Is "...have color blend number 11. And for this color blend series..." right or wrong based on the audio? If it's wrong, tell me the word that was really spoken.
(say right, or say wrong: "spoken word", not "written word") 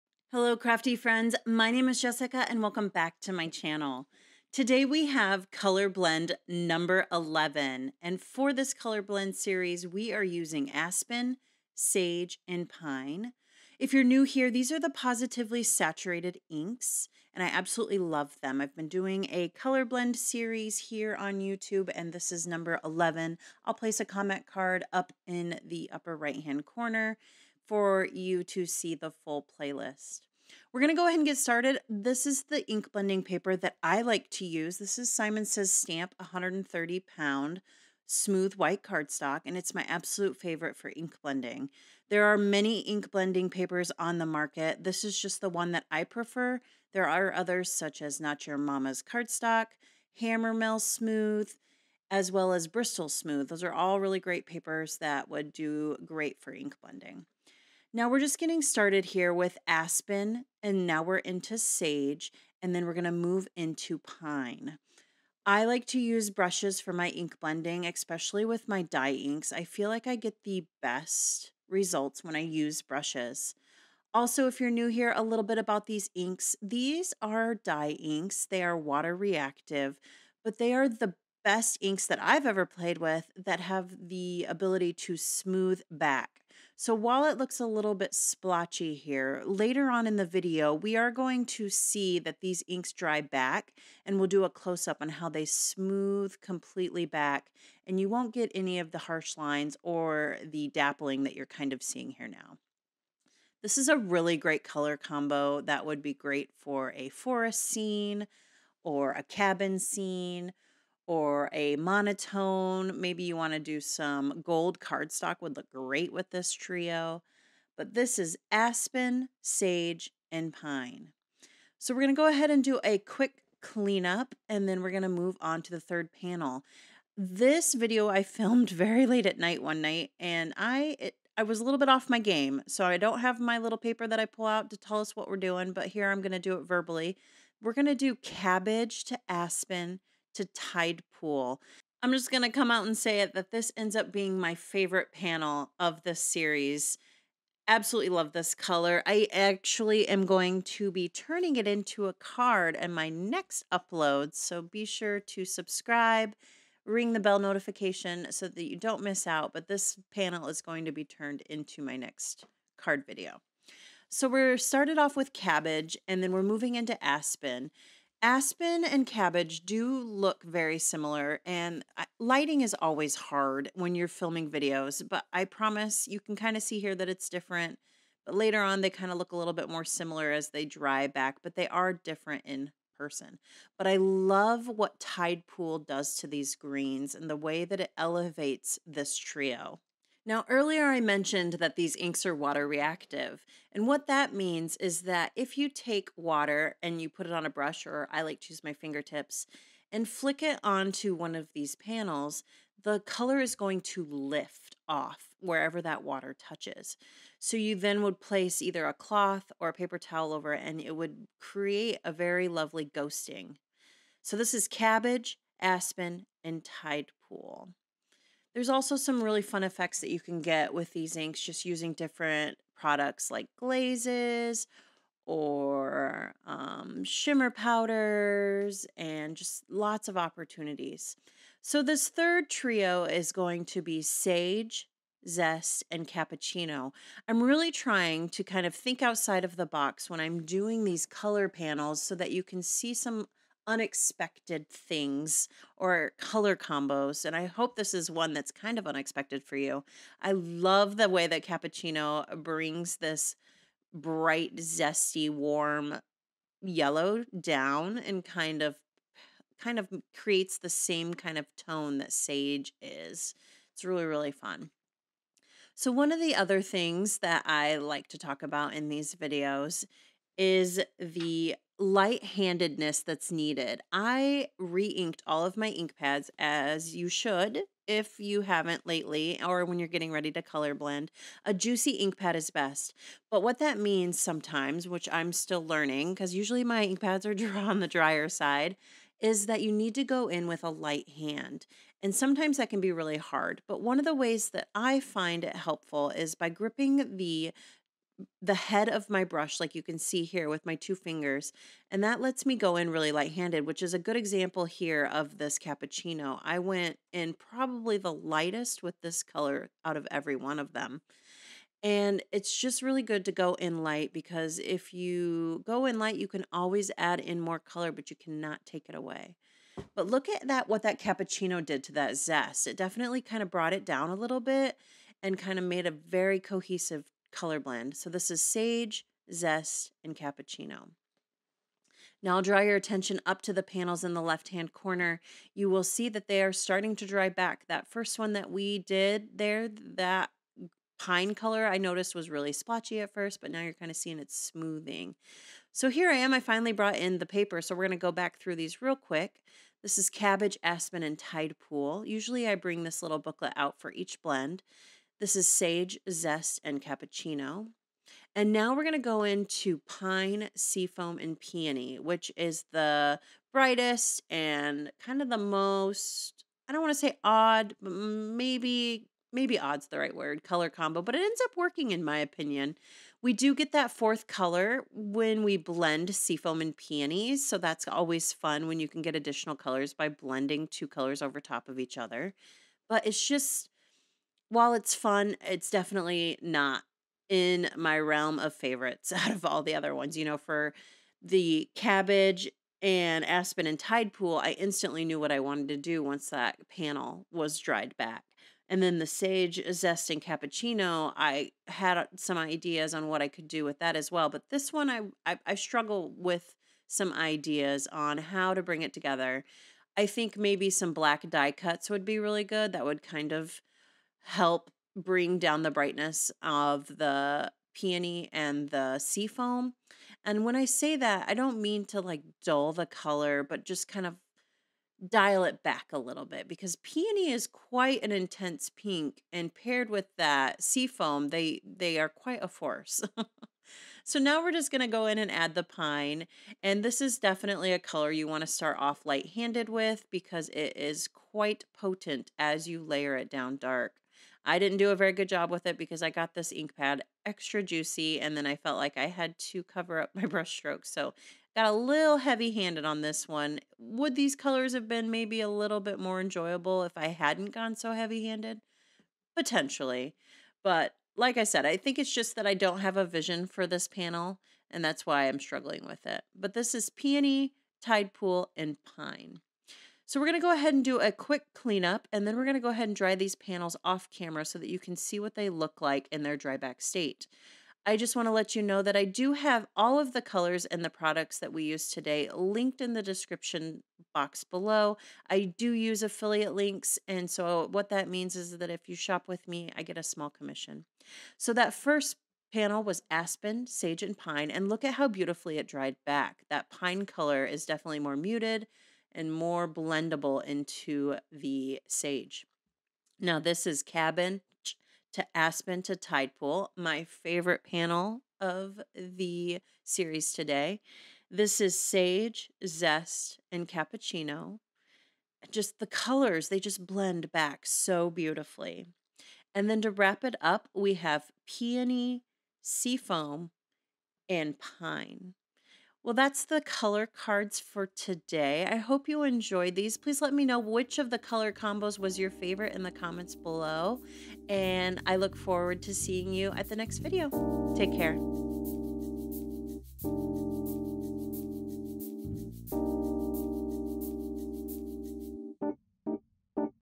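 right.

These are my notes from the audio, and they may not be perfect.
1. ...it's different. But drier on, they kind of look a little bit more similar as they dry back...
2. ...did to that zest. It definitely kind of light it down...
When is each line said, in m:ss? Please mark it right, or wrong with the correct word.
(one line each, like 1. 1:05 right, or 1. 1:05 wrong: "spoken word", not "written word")
1. 2:57 wrong: "later", not "drier"
2. 5:21 wrong: "brought", not "light".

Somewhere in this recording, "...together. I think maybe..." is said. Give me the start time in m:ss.
6:48.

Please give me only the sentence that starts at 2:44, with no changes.
So we're started off with cabbage and then we're moving into aspen.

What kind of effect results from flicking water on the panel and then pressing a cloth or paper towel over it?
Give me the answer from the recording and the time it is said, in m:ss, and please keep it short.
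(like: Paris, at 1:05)
ghosting, at 3:32.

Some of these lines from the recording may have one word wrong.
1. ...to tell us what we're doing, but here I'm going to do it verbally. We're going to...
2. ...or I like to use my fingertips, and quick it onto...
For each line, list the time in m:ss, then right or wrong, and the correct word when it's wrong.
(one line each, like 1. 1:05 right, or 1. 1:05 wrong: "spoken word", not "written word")
1. 2:14 right
2. 3:17 wrong: "flick", not "quick".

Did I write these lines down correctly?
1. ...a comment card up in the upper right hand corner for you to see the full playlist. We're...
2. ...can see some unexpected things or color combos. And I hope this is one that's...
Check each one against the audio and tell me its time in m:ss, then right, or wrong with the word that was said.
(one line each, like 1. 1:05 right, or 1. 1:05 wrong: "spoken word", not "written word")
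1. 0:23 right
2. 4:02 right.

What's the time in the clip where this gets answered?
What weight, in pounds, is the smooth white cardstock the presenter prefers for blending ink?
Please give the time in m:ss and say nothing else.
0:36.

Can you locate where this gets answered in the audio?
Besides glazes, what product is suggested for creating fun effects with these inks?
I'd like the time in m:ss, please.
3:47.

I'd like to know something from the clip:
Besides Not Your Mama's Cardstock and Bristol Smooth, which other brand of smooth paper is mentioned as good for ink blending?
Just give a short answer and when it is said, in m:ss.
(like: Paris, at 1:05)
Hammermill Smooth, at 0:50.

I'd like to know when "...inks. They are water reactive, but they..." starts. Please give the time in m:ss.
1:17.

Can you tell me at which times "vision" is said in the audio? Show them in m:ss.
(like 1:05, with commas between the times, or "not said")
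7:43.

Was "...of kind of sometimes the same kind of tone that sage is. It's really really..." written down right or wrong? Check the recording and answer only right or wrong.
wrong.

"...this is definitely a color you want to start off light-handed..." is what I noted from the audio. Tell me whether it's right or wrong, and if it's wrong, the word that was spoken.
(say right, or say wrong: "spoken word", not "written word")
right.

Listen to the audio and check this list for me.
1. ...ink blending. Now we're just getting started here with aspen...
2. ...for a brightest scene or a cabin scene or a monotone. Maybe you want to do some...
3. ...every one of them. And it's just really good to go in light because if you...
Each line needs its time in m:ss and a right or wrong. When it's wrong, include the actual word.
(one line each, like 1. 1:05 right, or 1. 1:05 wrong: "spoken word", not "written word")
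1. 0:56 right
2. 1:46 wrong: "forest", not "brightest"
3. 5:10 right.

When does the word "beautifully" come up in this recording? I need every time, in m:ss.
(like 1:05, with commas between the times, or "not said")
8:15, 8:38.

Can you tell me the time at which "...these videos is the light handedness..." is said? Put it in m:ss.
4:28.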